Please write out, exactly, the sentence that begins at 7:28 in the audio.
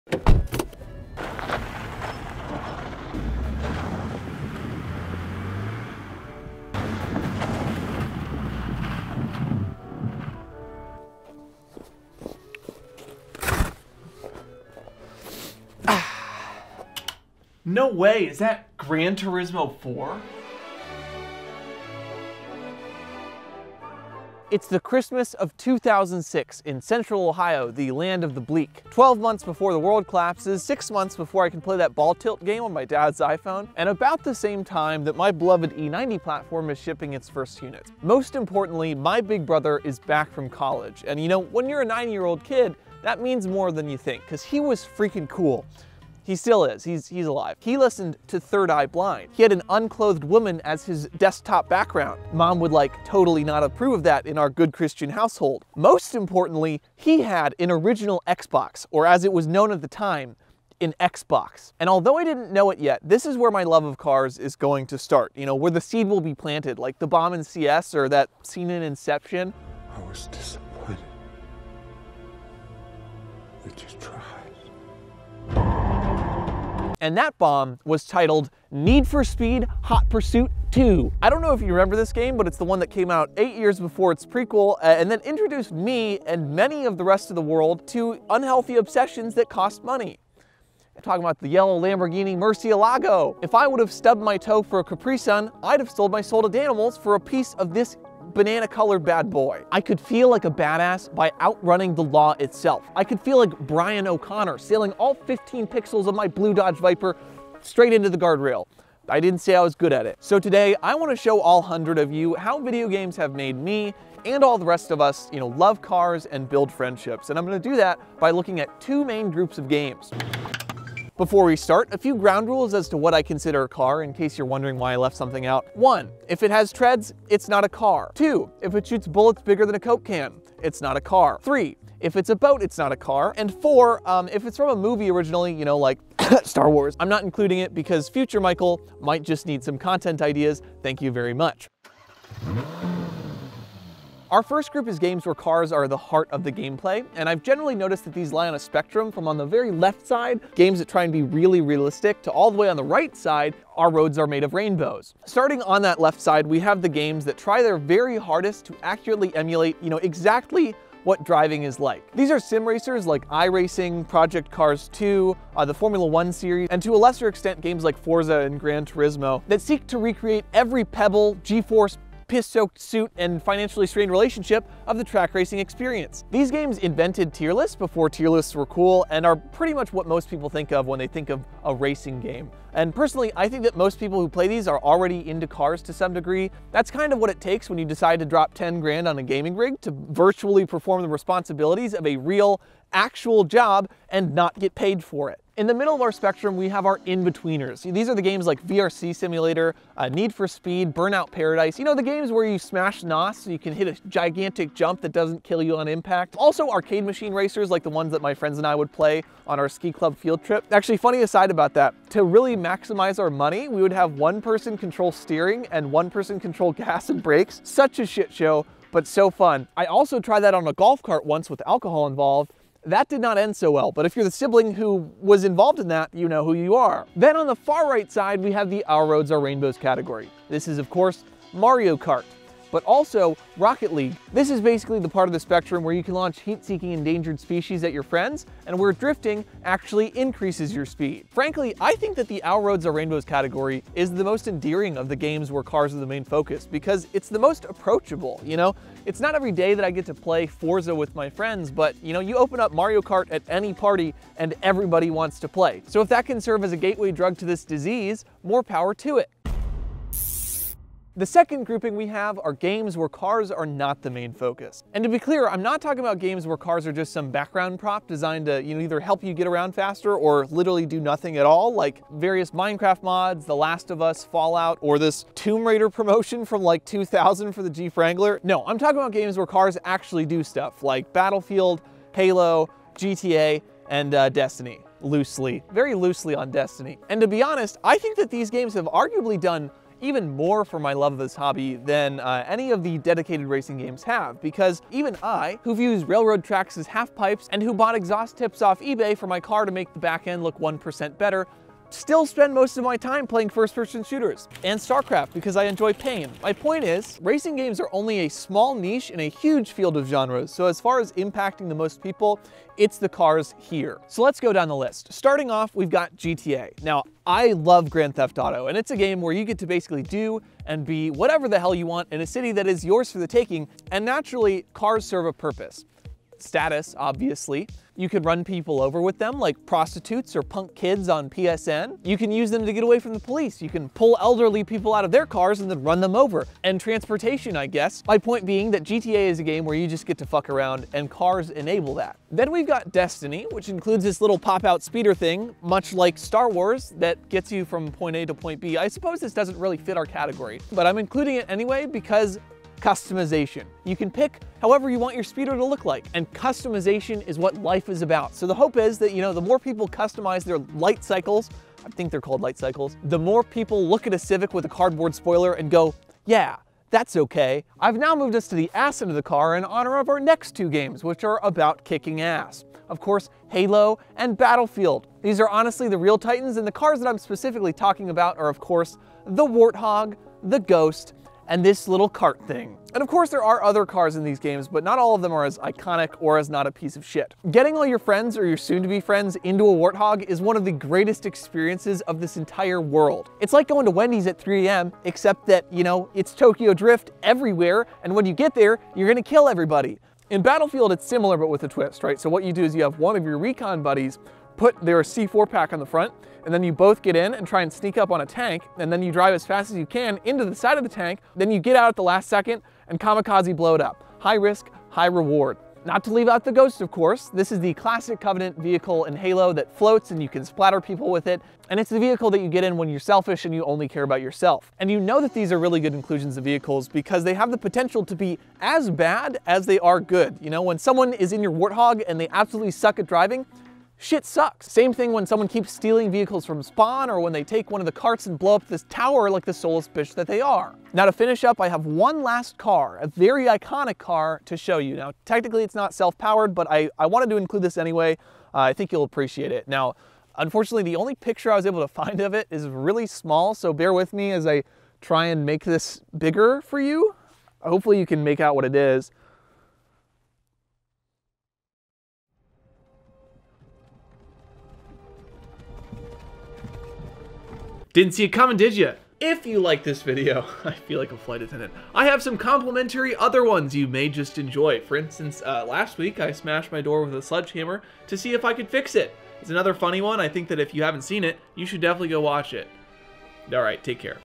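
Uh, I think you'll appreciate it.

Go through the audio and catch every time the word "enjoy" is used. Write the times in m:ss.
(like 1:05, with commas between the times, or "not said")
5:05, 7:54.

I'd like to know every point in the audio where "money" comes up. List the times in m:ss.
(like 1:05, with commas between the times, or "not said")
1:29, 3:33.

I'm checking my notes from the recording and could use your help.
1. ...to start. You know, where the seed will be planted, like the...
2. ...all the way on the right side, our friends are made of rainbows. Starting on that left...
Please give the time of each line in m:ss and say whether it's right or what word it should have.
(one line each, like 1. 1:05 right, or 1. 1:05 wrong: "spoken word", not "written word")
1. 1:04 right
2. 2:32 wrong: "roads", not "friends".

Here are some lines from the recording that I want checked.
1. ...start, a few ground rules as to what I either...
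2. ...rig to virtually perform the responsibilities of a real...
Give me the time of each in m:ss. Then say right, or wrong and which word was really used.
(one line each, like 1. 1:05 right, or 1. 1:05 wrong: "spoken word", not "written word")
1. 2:01 wrong: "consider", not "either"
2. 3:09 right.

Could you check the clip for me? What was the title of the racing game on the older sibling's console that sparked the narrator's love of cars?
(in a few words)
Need for Speed Hot Pursuit 2.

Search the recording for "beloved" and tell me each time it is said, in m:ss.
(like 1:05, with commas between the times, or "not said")
0:35.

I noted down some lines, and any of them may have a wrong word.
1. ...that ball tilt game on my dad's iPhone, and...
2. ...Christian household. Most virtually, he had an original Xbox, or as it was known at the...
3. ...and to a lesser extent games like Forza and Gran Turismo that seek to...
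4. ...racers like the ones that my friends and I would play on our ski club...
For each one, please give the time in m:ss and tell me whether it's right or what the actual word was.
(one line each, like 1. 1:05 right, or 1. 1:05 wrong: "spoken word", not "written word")
1. 0:31 right
2. 0:54 wrong: "importantly", not "virtually"
3. 2:46 right
4. 3:27 right.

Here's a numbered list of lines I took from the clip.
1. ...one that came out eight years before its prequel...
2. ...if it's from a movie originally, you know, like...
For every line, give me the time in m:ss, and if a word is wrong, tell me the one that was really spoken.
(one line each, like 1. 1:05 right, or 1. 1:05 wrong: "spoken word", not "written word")
1. 1:22 right
2. 2:14 right.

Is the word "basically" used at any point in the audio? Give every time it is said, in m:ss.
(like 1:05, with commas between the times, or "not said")
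3:54, 5:19.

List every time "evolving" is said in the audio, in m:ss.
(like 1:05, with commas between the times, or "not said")
not said.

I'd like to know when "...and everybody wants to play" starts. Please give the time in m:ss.
4:14.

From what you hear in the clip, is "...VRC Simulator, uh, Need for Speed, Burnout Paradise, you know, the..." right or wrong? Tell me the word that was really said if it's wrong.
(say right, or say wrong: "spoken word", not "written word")
right.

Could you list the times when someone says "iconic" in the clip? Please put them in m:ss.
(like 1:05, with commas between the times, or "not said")
6:25, 7:23.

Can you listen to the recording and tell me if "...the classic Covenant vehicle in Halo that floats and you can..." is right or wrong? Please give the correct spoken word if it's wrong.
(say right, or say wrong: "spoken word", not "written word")
right.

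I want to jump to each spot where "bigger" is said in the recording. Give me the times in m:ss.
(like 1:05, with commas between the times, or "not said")
2:09, 7:36.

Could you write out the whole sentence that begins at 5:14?
So let's go down the list.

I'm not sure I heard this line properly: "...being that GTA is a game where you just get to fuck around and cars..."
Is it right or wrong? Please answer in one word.
right.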